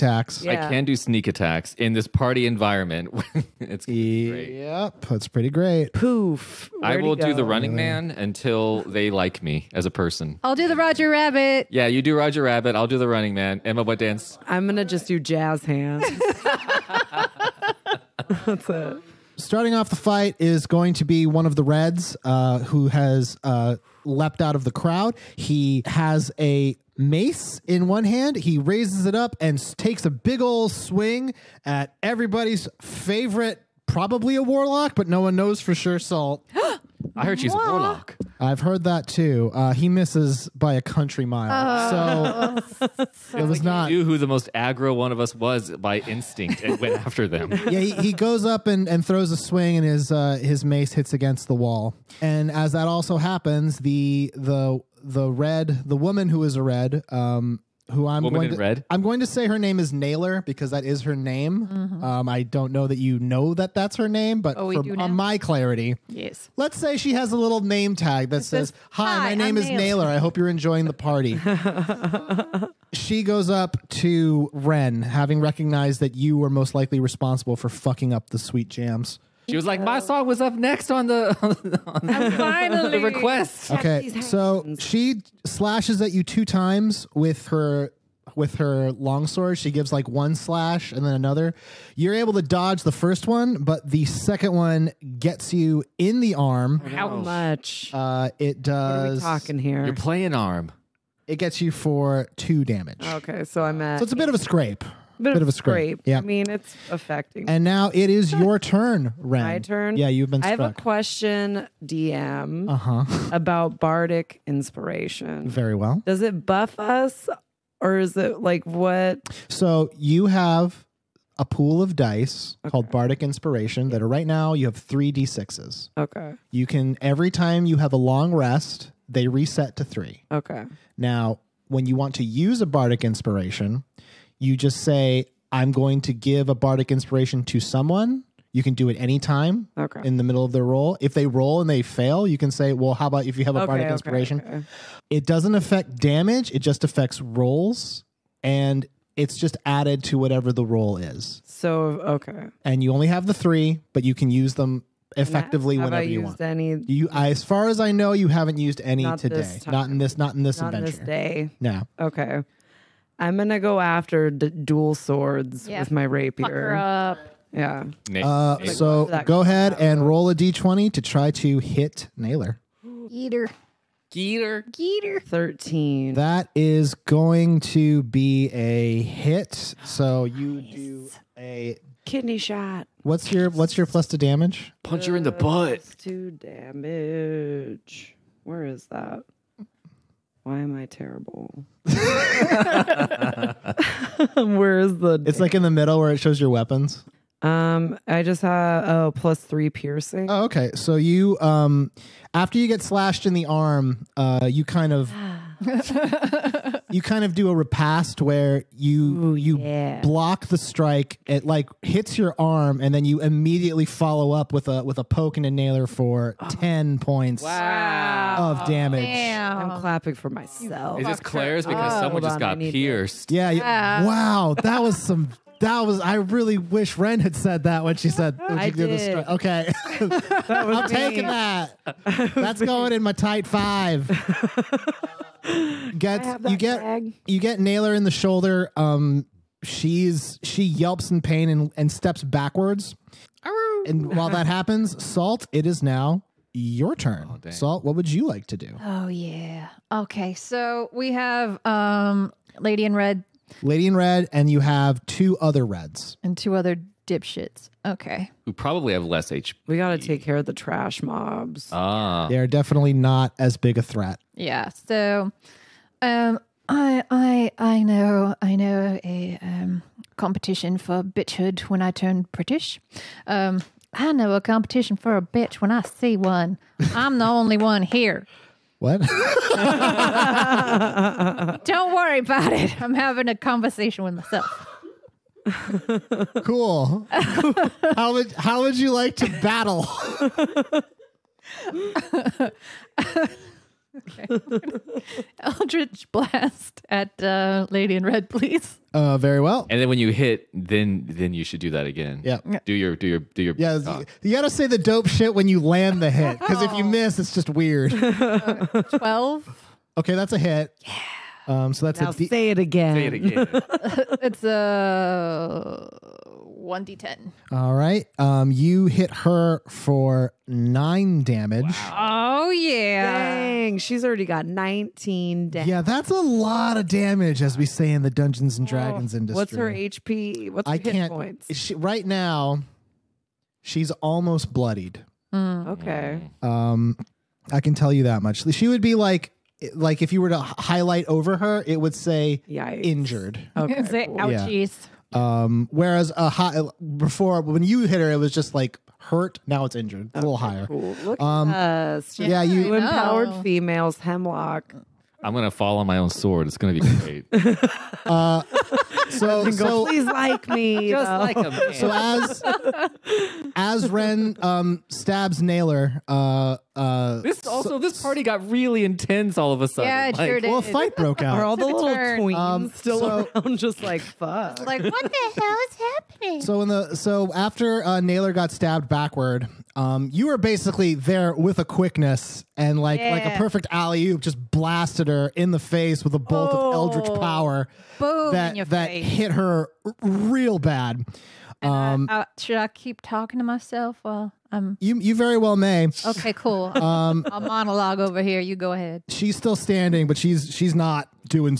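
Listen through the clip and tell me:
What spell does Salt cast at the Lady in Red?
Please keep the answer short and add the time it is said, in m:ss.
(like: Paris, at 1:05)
Eldritch blast, at 4:55.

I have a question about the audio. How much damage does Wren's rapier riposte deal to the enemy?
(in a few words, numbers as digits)
10.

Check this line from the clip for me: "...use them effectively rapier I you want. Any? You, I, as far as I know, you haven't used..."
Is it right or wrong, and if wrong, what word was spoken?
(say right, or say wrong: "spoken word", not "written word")
wrong: "whenever", not "rapier".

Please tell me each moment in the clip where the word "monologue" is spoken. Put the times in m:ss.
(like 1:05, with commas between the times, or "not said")
6:37.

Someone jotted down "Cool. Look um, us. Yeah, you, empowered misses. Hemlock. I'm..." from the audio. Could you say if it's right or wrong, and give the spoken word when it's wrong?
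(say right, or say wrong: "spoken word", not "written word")
wrong: "females", not "misses".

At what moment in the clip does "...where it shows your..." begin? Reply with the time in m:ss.
3:15.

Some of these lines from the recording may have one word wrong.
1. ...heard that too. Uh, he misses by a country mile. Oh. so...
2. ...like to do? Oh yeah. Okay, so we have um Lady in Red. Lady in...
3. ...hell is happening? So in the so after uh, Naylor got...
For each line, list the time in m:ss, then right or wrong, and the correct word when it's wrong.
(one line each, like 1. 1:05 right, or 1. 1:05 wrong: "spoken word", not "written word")
1. 0:38 right
2. 4:08 right
3. 6:15 right.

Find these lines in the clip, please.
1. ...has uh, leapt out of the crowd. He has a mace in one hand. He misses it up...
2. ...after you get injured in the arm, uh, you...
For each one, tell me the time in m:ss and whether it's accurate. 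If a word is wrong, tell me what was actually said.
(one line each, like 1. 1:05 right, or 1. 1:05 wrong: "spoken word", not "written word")
1. 0:22 wrong: "raises", not "misses"
2. 3:22 wrong: "slashed", not "injured".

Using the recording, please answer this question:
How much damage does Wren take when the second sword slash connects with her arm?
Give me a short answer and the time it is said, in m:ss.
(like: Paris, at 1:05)
2, at 1:41.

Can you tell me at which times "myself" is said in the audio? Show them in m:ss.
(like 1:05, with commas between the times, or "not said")
3:40, 4:44, 6:33.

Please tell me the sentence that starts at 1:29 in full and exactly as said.
She gives like one slash and then another.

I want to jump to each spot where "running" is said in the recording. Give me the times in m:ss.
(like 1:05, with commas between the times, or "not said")
0:07, 0:13.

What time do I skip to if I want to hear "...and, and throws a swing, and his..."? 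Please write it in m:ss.
0:48.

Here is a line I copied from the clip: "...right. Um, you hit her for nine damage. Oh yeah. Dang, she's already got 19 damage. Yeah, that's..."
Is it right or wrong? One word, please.
right.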